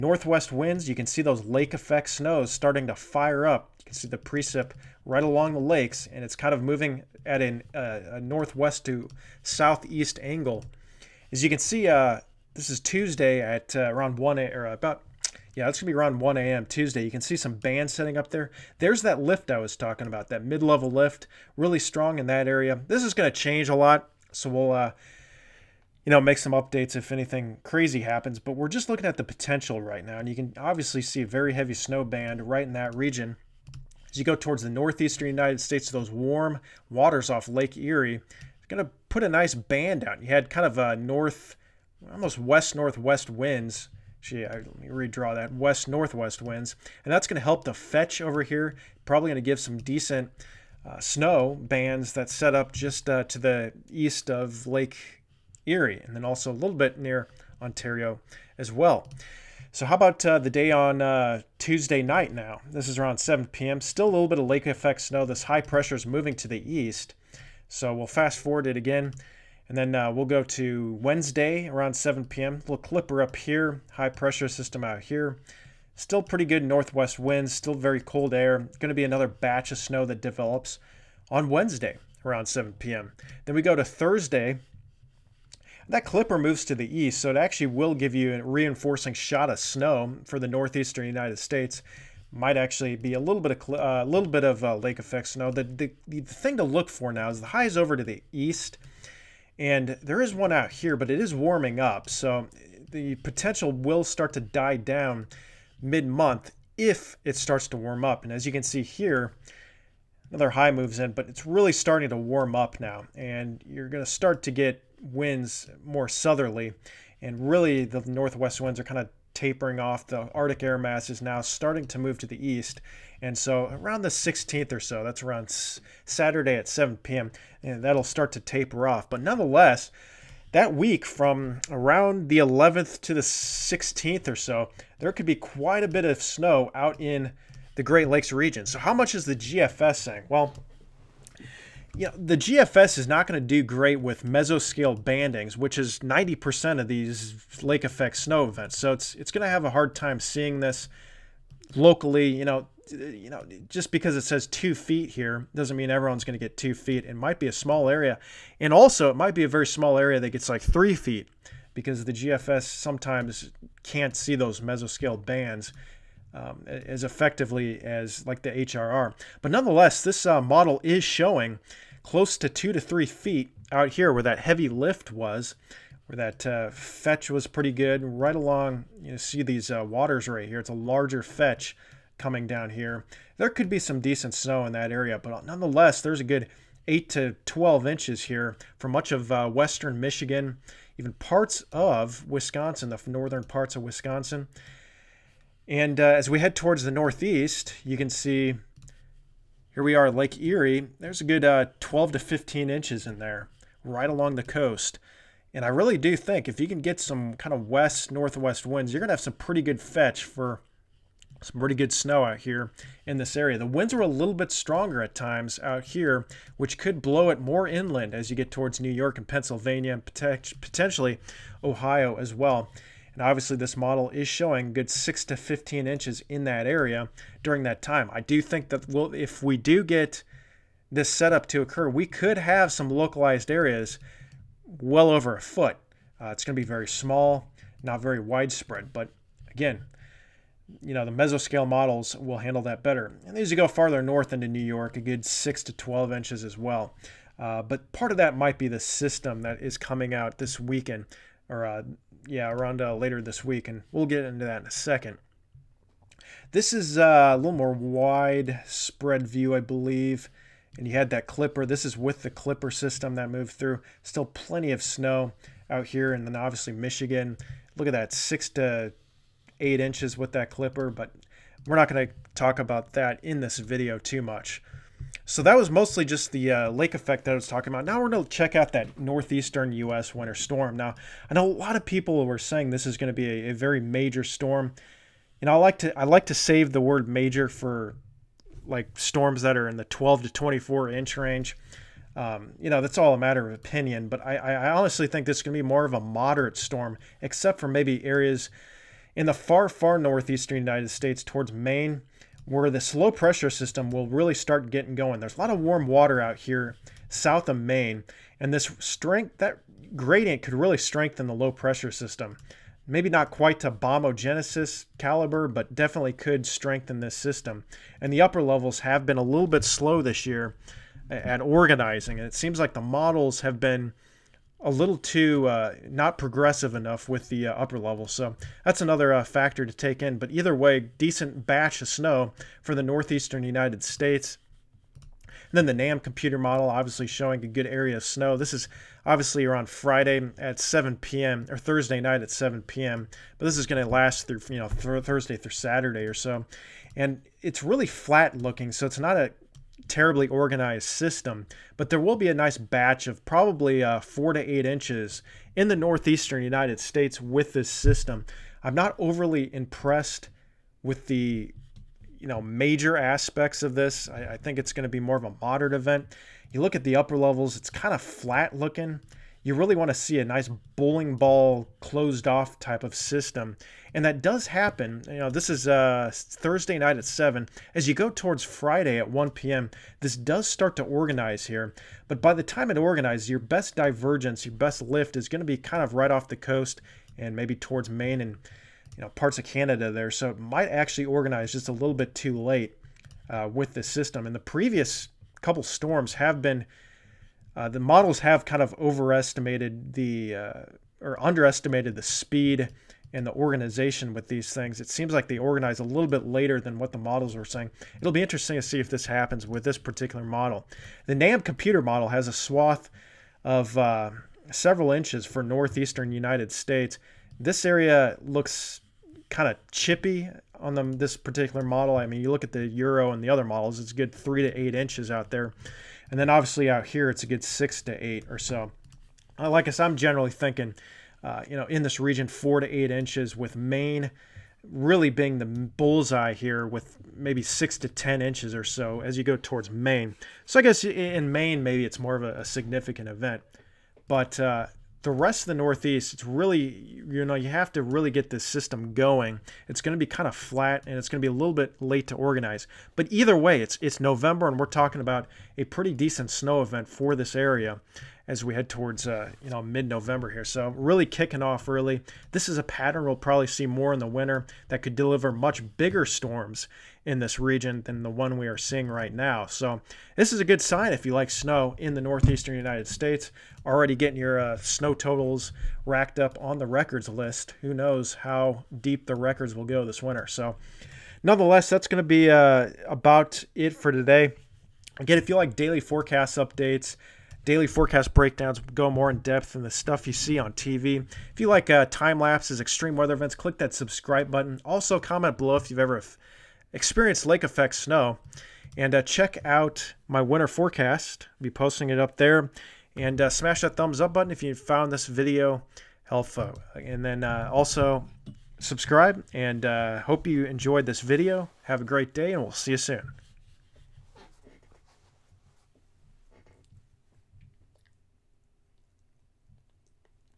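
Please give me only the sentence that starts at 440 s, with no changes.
So I guess in Maine, maybe it's more of a, significant event.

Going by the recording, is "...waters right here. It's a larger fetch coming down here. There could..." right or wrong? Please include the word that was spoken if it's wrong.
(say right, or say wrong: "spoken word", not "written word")
right.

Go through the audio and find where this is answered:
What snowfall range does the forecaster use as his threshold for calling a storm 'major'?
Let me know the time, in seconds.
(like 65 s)
289 s.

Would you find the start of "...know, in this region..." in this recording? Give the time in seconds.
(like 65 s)
431 s.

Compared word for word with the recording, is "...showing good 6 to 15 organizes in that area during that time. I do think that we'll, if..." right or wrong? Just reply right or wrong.
wrong.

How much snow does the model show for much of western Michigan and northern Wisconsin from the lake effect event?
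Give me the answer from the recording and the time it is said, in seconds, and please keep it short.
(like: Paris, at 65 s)
8 to 12 inches, at 186 s.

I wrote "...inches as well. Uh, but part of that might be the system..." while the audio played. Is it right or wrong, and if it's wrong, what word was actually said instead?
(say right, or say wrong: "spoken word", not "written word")
right.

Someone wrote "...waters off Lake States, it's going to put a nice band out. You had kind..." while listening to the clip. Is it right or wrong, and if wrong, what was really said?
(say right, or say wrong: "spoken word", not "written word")
wrong: "Erie", not "States".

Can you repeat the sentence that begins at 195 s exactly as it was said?
And uh, as we head towards the northeast, you can see here we are, Lake Erie.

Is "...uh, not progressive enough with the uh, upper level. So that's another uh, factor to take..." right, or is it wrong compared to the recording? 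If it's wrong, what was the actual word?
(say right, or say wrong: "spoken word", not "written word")
right.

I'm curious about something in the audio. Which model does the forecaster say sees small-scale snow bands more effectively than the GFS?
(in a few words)
HRR.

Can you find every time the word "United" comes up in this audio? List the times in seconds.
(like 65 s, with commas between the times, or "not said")
35 s, 91 s, 300 s, 333 s, 356 s, 416 s, 472 s.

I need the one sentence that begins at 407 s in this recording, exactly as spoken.
It'll be interesting to see if this happens with this particular model.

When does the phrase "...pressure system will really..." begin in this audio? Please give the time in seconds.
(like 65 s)
303 s.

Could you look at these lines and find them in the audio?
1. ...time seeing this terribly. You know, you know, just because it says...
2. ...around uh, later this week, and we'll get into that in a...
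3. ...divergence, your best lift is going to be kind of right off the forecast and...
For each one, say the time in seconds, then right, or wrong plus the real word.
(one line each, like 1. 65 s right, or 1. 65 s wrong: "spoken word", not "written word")
1. 149 s wrong: "locally", not "terribly"
2. 252 s right
3. 383 s wrong: "coast", not "forecast".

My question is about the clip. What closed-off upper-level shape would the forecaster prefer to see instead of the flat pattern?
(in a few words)
bowling ball.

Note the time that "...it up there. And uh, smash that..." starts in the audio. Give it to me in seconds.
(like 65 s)
501 s.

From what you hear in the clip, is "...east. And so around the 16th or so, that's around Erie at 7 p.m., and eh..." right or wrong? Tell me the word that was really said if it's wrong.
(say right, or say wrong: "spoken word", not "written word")
wrong: "Saturday", not "Erie".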